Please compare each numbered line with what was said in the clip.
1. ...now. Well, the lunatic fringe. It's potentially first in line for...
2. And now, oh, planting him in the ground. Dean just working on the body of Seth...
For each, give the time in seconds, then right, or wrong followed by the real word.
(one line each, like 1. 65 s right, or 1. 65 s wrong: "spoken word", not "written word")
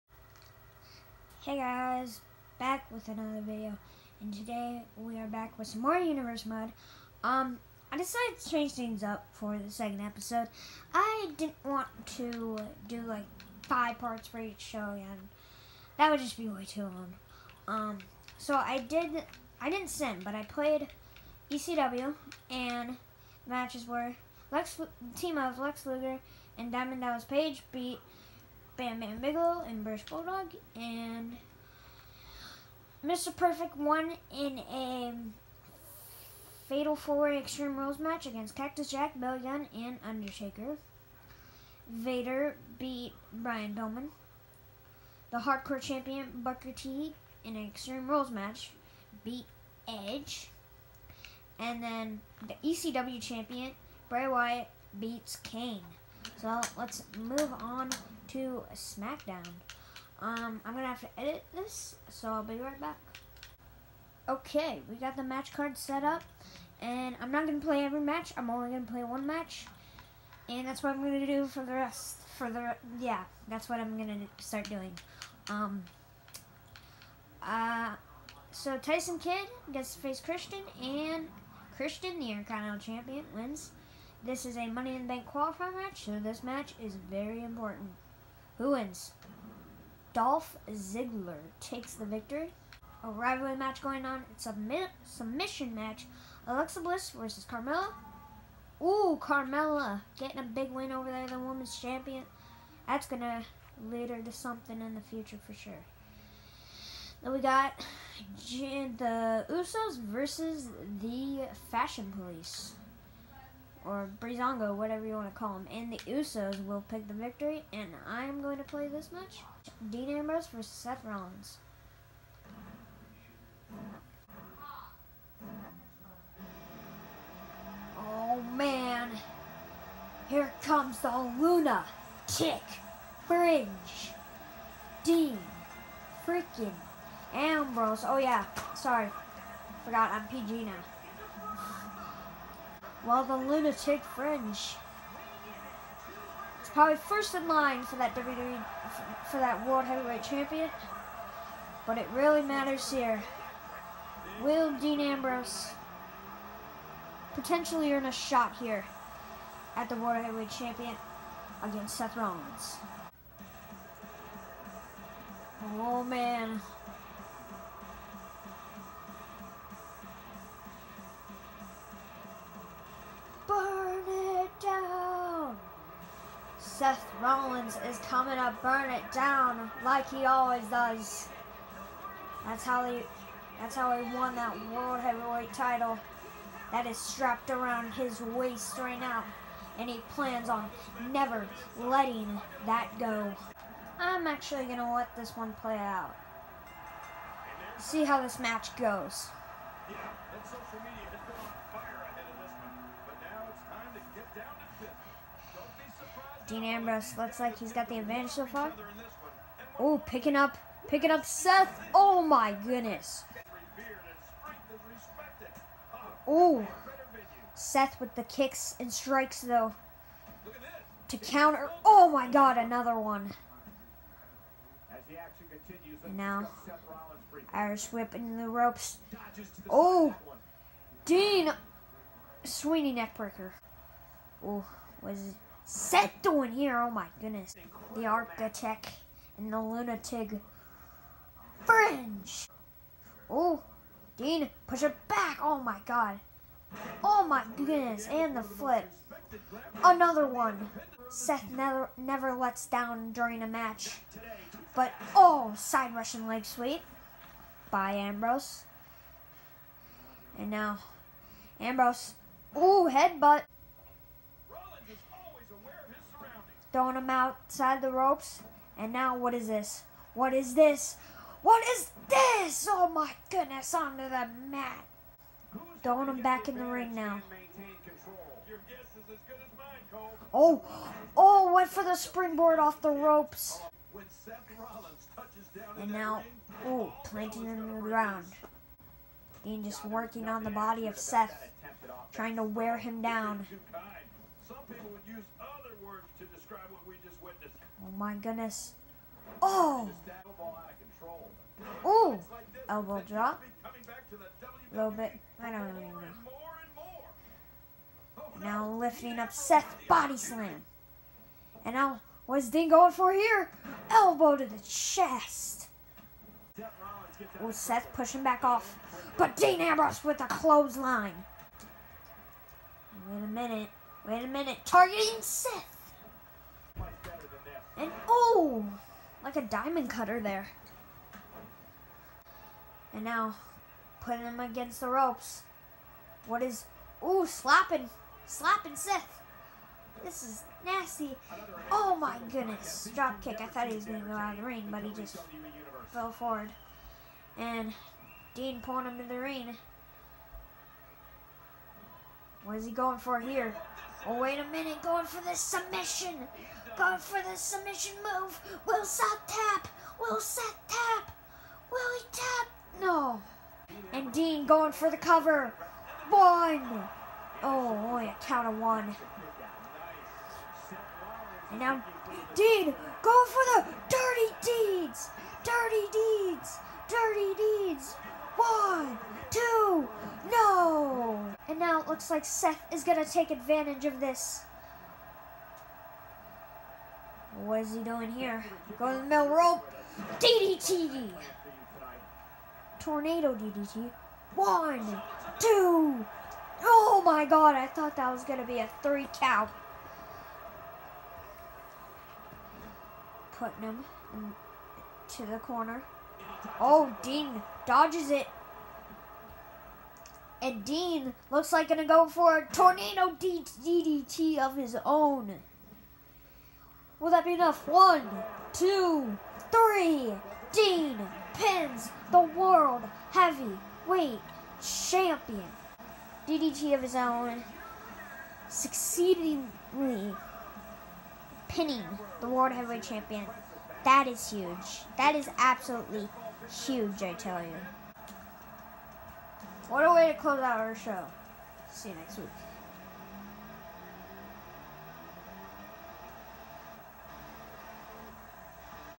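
1. 140 s wrong: "probably", not "potentially"
2. 285 s right.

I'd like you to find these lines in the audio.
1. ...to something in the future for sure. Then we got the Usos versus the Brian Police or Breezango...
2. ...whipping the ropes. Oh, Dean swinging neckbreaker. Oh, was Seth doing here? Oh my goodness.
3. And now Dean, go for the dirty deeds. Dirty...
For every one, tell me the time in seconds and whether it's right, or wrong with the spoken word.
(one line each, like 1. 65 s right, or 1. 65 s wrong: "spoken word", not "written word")
1. 104 s wrong: "Fashion", not "Brian"
2. 227 s right
3. 371 s right.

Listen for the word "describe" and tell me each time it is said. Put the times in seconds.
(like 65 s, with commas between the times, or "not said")
296 s.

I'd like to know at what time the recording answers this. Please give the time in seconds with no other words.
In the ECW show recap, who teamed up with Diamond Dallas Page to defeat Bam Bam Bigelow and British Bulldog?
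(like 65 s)
25 s.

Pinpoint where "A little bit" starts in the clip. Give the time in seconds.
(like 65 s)
303 s.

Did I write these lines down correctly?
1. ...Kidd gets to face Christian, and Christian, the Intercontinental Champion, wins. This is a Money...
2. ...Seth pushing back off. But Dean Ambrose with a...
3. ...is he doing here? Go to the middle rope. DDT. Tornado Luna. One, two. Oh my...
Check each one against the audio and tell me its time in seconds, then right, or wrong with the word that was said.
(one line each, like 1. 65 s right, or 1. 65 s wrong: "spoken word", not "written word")
1. 79 s right
2. 317 s right
3. 387 s wrong: "DDT", not "Luna".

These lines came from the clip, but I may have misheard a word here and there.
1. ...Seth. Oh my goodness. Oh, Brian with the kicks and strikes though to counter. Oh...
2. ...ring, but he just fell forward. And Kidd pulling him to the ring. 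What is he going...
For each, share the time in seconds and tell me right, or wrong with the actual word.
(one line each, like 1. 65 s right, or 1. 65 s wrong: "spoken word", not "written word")
1. 211 s wrong: "Seth", not "Brian"
2. 344 s wrong: "Dean", not "Kidd".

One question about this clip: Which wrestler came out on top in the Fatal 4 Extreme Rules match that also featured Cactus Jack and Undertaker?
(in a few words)
Mr. Perfect.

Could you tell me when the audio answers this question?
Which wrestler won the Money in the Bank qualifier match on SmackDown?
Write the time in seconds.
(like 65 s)
90 s.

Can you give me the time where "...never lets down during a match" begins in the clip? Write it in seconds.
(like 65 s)
251 s.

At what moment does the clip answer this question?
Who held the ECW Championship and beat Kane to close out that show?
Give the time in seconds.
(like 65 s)
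54 s.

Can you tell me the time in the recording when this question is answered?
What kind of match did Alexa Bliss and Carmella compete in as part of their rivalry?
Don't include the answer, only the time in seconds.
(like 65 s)
95 s.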